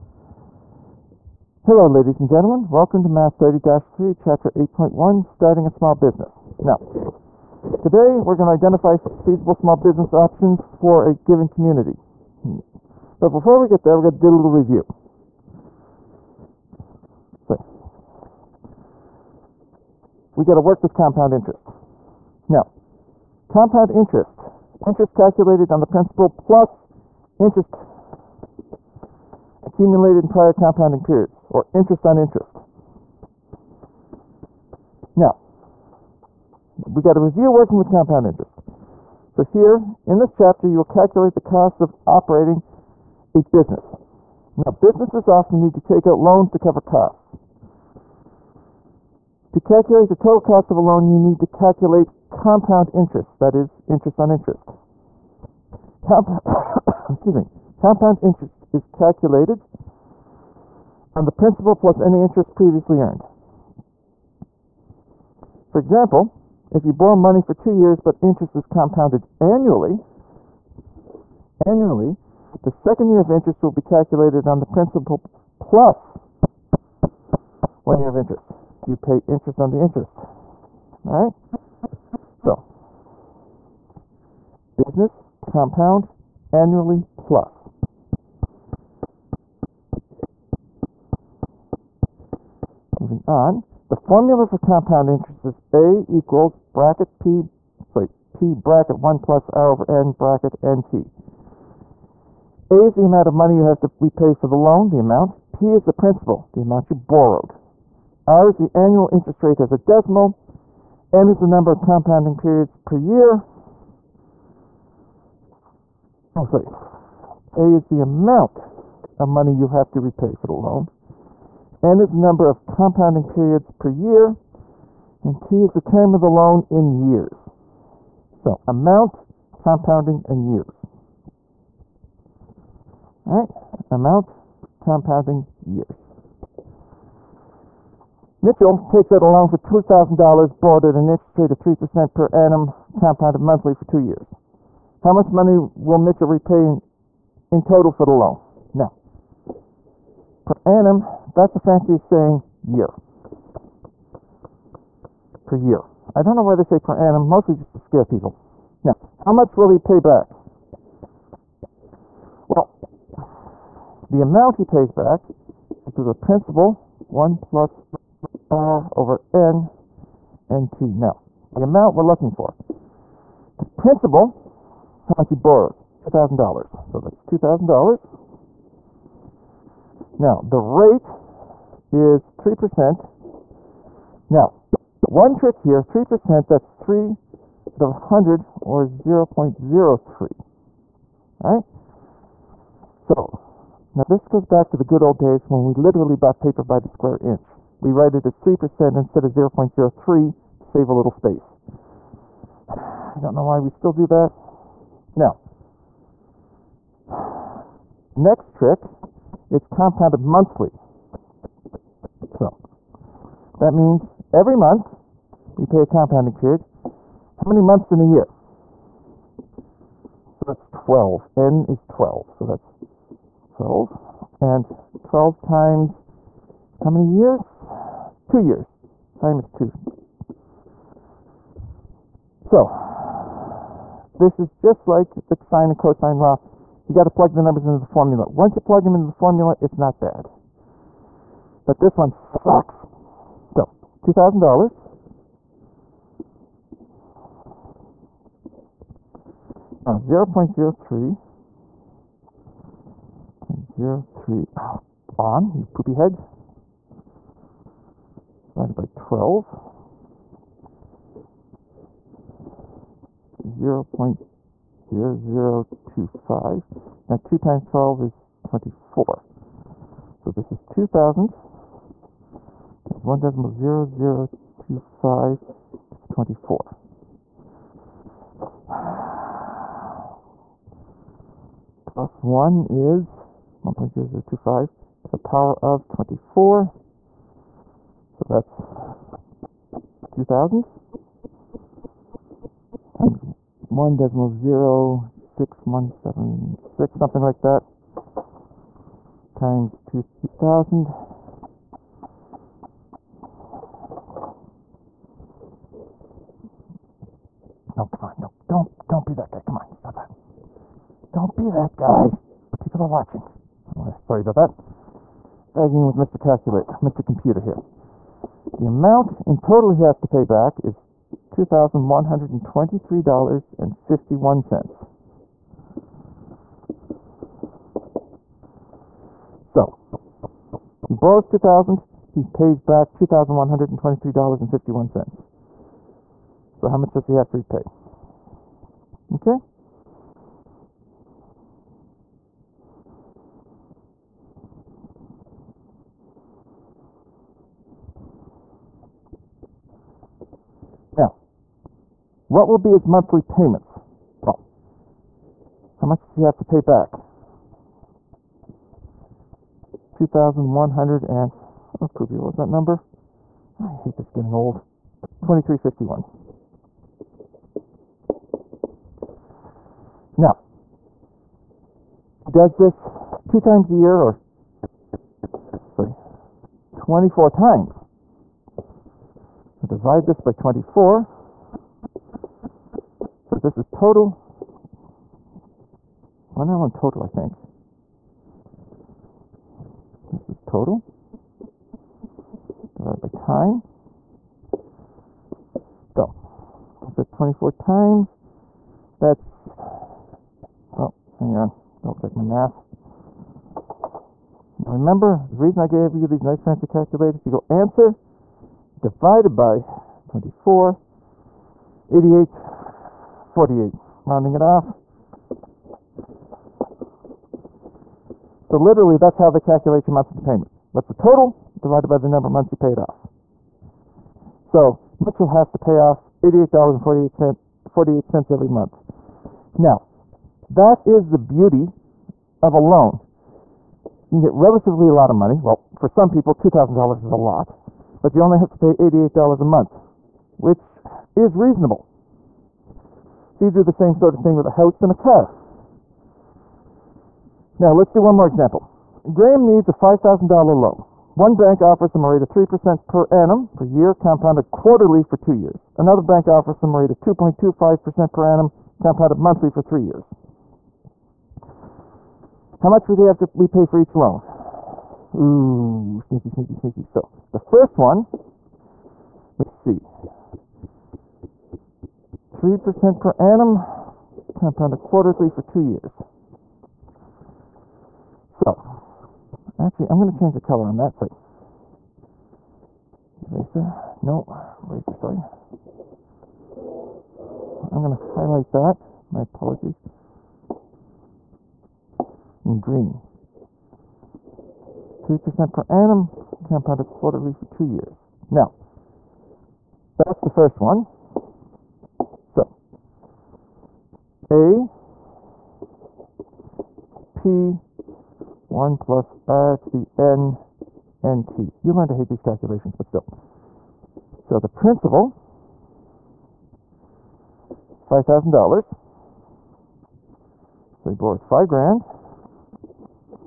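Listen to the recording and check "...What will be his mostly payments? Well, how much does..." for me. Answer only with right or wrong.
wrong.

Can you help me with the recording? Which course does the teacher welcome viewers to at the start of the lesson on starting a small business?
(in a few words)
Math 30-3.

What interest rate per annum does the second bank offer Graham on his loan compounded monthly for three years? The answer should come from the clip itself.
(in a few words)
2.25%.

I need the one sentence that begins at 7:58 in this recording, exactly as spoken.
So, actually, I'm going to change the color on that Sorry, Eraser, no, eraser, sorry.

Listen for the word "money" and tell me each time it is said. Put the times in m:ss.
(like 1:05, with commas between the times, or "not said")
1:07, 1:43, 1:59, 2:25, 7:15.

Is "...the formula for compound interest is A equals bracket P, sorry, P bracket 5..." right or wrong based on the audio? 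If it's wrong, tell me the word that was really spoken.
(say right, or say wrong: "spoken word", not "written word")
wrong: "1", not "5".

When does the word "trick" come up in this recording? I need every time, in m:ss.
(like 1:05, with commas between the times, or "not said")
3:05, 3:28.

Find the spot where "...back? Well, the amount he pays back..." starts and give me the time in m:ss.
2:39.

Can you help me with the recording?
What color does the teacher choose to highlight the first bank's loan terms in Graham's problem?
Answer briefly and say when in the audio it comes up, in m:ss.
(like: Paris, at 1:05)
green, at 8:12.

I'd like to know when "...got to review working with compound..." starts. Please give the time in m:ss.
0:37.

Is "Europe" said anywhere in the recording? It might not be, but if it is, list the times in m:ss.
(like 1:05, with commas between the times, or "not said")
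not said.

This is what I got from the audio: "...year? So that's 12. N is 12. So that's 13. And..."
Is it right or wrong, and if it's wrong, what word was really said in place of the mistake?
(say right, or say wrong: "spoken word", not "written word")
wrong: "12", not "13".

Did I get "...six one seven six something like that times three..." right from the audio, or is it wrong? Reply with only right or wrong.
wrong.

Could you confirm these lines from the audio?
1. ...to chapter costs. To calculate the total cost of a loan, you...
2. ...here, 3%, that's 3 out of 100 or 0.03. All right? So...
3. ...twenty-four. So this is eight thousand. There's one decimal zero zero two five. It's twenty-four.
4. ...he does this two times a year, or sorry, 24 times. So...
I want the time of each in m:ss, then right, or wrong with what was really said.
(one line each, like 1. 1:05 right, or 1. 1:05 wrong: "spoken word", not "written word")
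1. 0:46 wrong: "cover", not "chapter"
2. 3:05 right
3. 4:28 wrong: "two", not "eight"
4. 6:12 right.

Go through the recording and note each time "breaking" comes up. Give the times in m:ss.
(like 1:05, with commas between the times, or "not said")
not said.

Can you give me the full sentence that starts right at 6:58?
So literally, that's how they calculate your monthly payment.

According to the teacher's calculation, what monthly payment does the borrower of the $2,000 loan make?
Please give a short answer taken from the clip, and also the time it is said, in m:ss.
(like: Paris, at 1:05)
$88.48, at 7:06.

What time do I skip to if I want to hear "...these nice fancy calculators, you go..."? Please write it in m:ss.
6:46.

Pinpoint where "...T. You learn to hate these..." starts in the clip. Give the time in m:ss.
8:31.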